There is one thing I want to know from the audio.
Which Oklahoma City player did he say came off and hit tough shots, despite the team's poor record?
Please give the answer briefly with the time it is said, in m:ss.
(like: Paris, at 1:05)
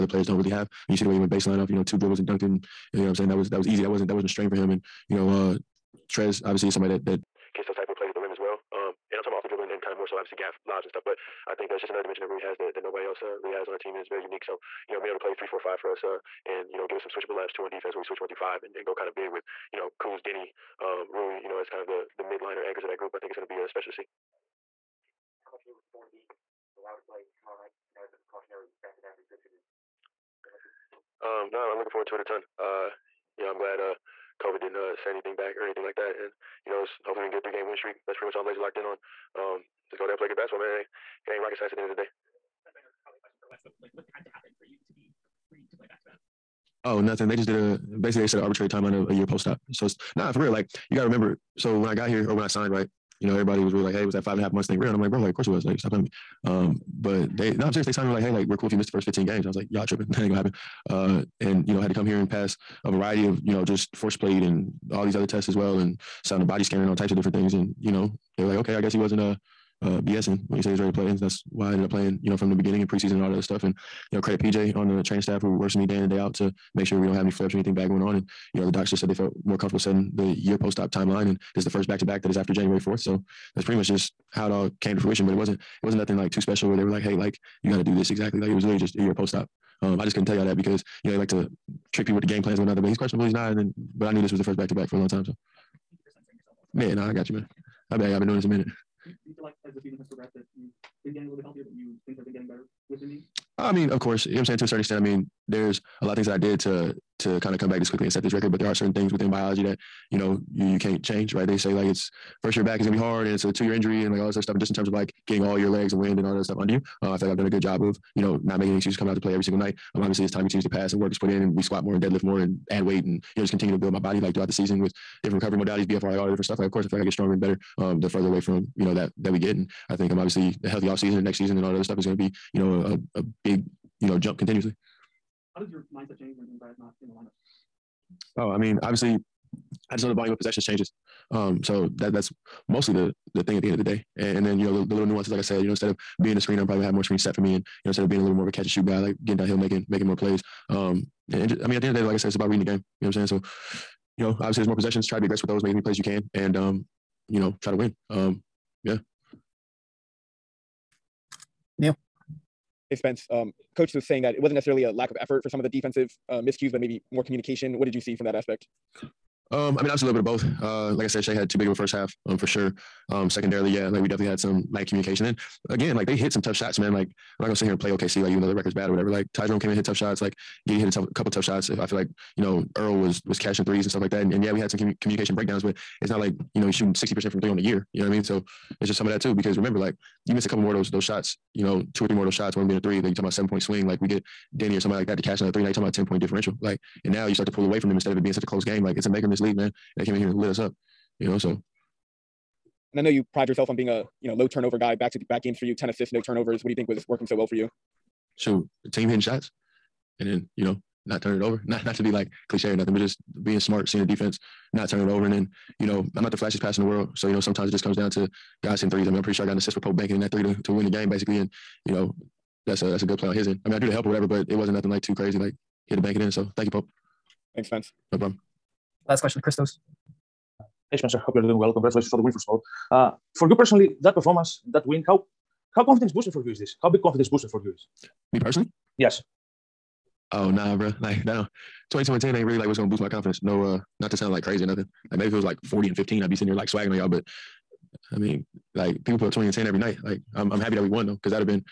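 Ty Jerome, at 2:59.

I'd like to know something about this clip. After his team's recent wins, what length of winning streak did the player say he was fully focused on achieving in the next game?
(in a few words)
3 games.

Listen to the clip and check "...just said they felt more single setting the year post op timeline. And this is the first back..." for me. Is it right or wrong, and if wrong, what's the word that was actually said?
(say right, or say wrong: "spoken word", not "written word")
wrong: "comfortable", not "single".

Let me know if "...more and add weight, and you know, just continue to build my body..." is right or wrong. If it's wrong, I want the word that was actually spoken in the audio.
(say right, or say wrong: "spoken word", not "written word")
right.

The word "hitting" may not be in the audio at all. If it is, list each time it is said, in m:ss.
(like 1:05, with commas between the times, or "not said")
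3:29, 3:38.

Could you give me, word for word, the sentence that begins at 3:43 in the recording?
I mean, I drew the help or whatever, but it wasn't nothing like too crazy.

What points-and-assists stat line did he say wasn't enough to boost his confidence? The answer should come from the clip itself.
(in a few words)
22 and 10.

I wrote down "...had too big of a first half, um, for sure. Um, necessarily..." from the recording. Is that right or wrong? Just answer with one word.
wrong.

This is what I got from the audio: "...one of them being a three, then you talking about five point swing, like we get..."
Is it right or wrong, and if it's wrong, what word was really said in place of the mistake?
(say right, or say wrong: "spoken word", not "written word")
wrong: "seven", not "five".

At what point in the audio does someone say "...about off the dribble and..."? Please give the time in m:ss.
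0:09.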